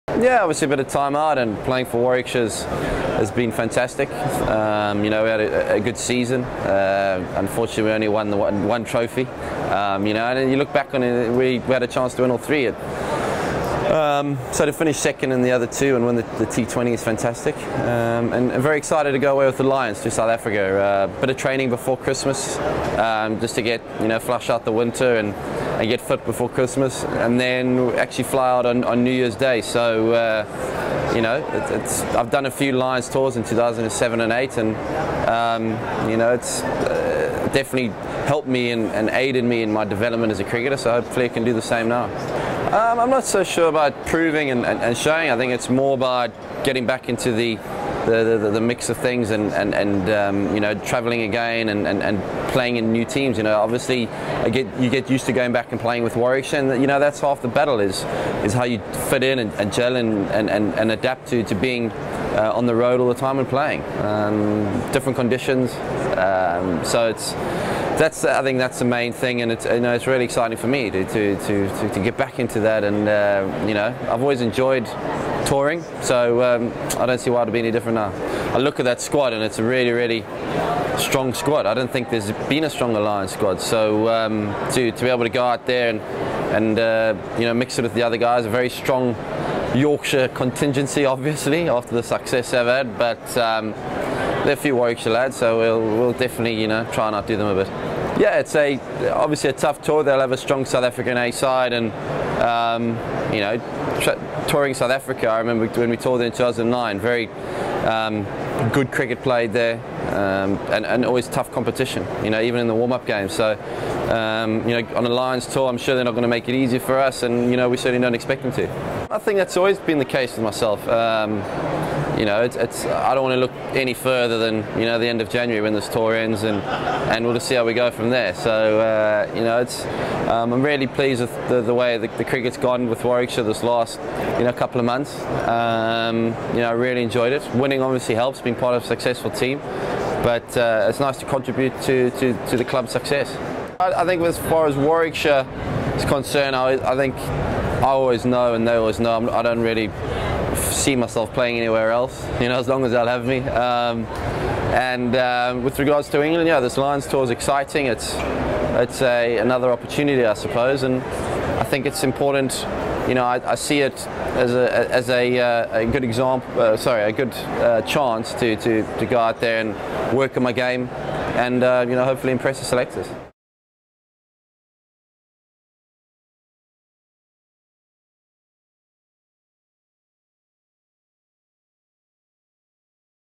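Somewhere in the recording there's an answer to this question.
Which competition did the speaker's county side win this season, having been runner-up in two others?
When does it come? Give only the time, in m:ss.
0:16.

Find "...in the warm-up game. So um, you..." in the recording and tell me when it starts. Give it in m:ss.
1:52.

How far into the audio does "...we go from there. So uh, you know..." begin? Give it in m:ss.
2:07.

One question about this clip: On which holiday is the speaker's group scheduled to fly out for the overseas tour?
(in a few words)
New Year's Day.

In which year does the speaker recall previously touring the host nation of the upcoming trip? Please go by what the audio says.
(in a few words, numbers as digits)
2009.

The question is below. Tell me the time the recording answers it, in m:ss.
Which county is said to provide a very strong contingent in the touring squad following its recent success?
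1:29.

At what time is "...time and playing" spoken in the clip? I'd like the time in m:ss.
1:03.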